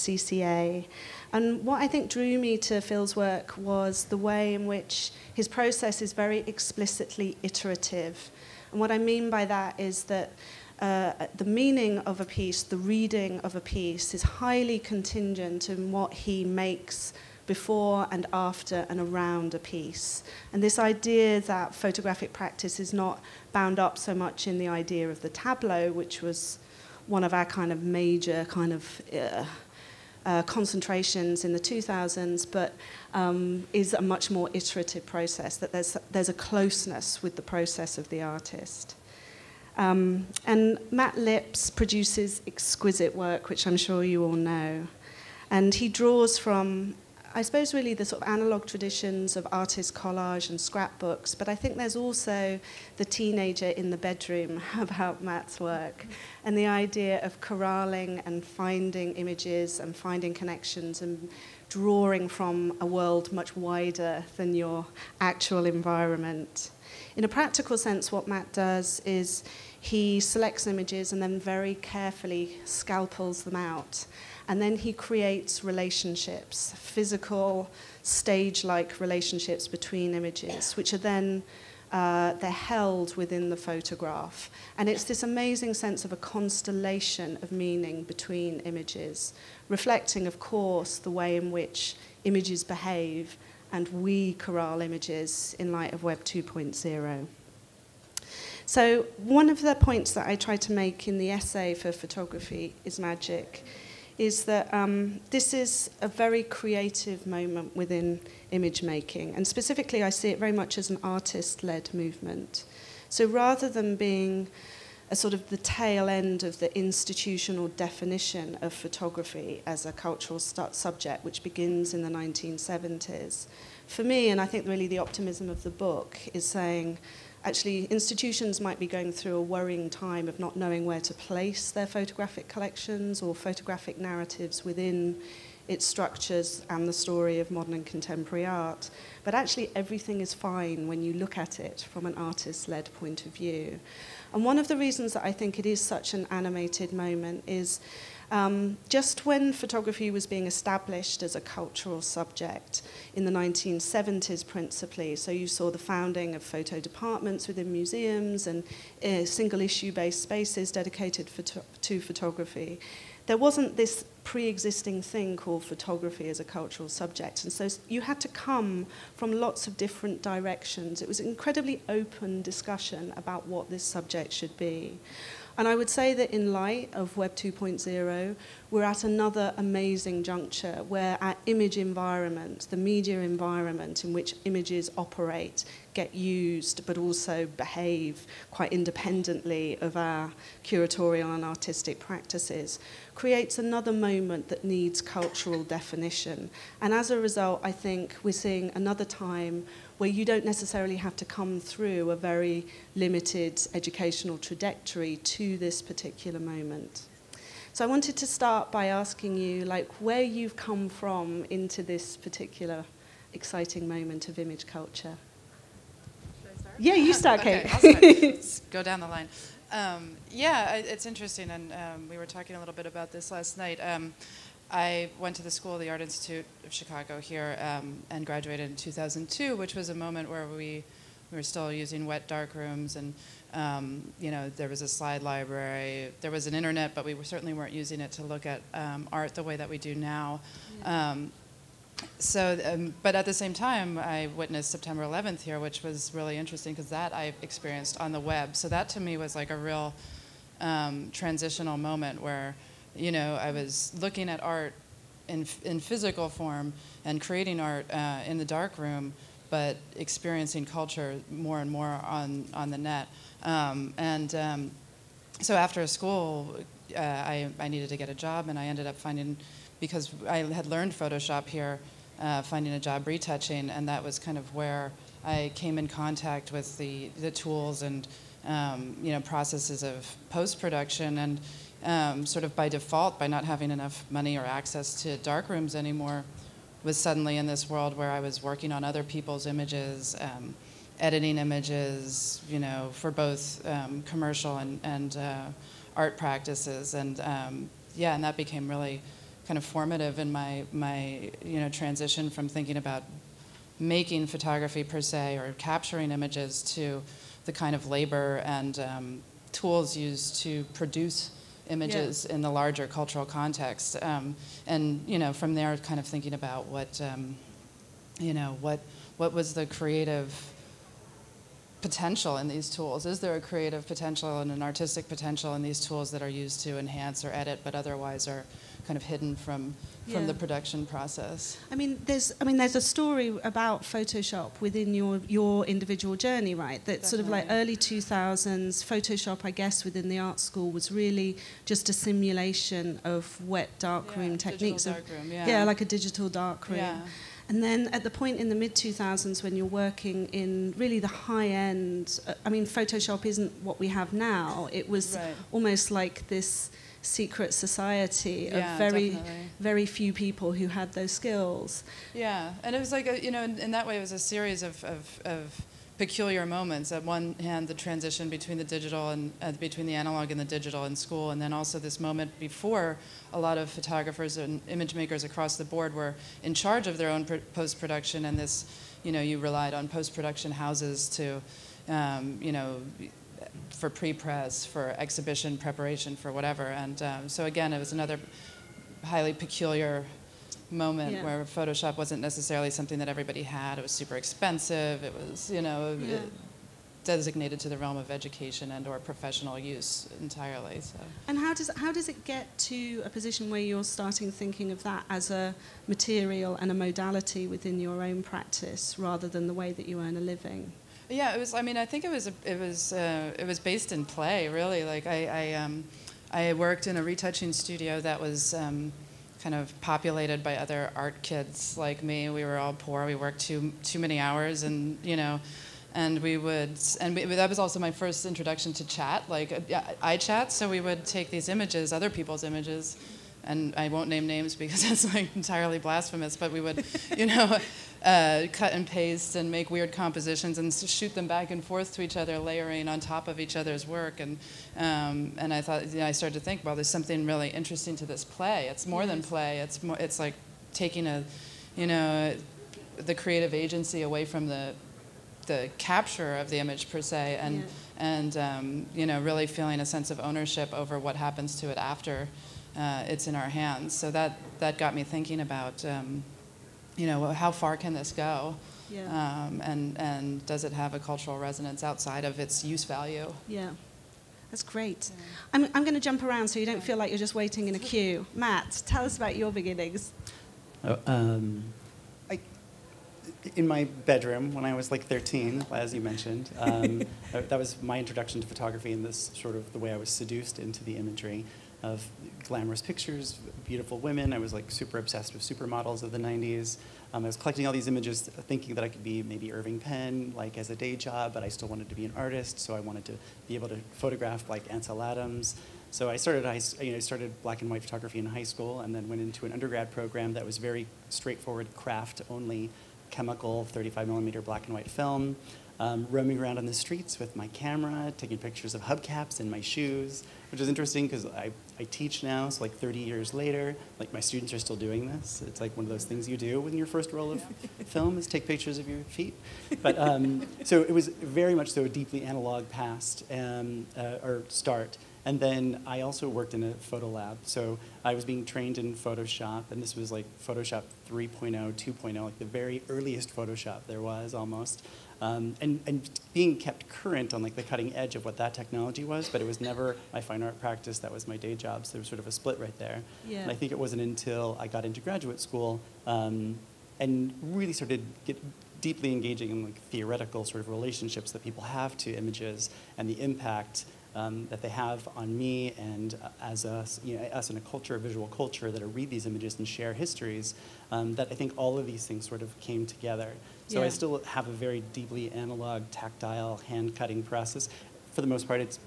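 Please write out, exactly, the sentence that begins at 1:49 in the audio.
And specifically, I see it very much as an artist led movement.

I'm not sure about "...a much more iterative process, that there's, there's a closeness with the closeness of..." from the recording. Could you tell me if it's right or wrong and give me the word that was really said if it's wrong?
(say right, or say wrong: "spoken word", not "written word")
wrong: "process", not "closeness".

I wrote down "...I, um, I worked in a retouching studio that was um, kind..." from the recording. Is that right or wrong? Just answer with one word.
right.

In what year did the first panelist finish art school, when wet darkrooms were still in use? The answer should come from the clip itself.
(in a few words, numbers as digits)
2002.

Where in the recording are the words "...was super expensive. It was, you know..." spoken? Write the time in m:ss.
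6:33.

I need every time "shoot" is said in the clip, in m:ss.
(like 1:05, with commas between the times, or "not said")
7:20.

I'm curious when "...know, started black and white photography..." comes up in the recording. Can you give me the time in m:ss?
8:26.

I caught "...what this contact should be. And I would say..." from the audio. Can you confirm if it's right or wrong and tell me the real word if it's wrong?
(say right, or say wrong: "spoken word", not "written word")
wrong: "subject", not "contact".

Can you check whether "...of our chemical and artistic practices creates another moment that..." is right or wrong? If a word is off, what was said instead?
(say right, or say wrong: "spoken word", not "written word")
wrong: "curatorial", not "chemical".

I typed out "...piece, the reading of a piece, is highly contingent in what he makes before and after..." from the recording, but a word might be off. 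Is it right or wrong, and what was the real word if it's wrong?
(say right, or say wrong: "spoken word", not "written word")
right.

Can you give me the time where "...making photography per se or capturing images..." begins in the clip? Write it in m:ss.
5:03.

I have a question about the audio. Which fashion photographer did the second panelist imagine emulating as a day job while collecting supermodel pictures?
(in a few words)
Irving Penn.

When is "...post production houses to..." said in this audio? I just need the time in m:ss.
6:19.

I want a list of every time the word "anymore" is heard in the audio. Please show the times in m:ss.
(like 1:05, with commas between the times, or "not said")
4:45.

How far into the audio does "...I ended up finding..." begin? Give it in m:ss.
4:28.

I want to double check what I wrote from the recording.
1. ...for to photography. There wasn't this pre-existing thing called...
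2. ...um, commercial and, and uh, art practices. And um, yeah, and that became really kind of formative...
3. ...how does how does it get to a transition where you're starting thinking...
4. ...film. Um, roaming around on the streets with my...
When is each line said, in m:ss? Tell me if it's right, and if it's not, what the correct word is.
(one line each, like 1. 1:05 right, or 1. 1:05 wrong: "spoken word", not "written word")
1. 2:41 right
2. 4:53 right
3. 6:41 wrong: "position", not "transition"
4. 8:34 right.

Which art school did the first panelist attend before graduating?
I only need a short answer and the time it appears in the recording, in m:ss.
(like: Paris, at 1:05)
School of the Art Institute of Chicago, at 3:45.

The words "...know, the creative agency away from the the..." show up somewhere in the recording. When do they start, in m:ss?
7:31.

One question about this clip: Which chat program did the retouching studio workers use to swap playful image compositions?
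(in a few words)
iChat.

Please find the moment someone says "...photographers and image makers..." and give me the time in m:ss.
6:13.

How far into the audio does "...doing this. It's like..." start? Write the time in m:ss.
8:44.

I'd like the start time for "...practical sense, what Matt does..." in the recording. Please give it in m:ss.
1:07.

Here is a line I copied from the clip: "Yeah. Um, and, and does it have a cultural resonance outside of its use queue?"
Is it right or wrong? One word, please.
wrong.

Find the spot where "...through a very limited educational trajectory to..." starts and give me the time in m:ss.
3:21.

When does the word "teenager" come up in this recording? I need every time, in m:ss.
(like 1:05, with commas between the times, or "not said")
0:53.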